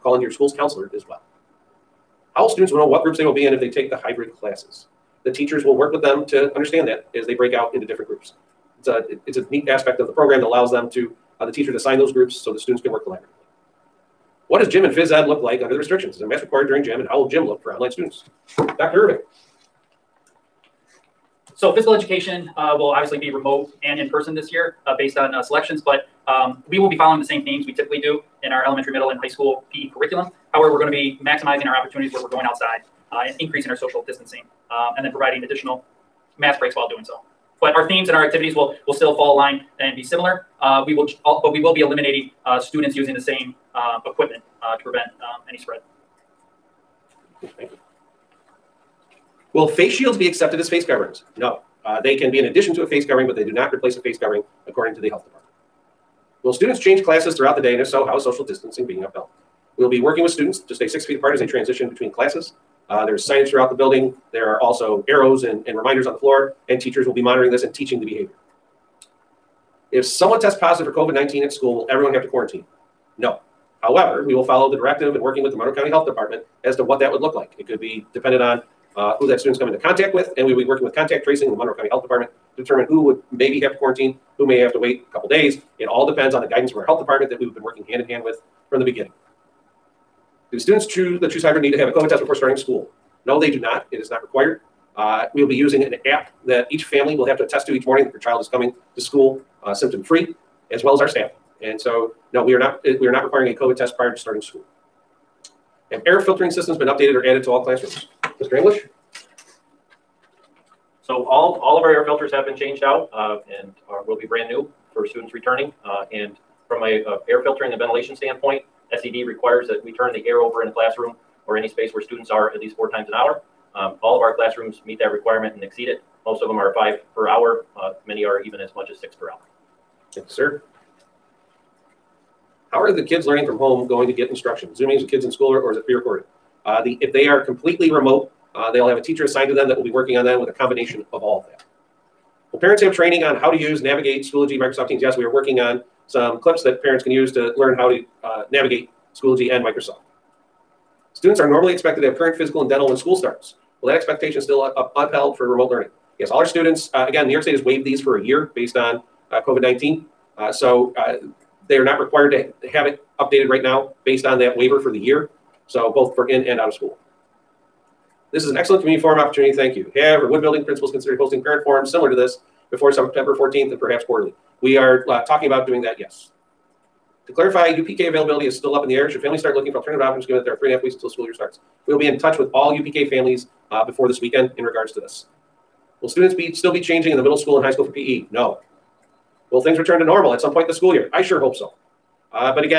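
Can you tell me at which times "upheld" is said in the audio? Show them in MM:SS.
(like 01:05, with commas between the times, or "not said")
00:59, 02:34.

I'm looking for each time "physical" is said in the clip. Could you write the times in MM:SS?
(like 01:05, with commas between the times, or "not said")
00:21, 02:32.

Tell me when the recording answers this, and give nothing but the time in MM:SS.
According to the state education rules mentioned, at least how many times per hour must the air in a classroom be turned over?
02:02.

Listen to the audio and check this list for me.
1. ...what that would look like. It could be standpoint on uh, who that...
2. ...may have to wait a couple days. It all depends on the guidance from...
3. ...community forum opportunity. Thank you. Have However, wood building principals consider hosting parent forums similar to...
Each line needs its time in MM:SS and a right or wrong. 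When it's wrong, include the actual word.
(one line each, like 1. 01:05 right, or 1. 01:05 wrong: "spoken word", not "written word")
1. 01:16 wrong: "dependent", not "standpoint"
2. 01:24 right
3. 02:48 right.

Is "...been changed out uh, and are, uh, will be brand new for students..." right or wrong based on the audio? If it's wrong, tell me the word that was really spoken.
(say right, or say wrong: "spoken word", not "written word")
right.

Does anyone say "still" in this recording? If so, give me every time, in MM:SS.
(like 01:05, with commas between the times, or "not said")
00:38, 02:34, 02:58, 03:06.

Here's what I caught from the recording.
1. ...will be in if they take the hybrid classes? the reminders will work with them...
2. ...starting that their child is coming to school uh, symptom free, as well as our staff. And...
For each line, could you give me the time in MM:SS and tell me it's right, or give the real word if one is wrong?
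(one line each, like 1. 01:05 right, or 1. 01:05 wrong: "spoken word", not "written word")
1. 00:03 wrong: "teachers", not "reminders"
2. 01:37 wrong: "morning", not "starting".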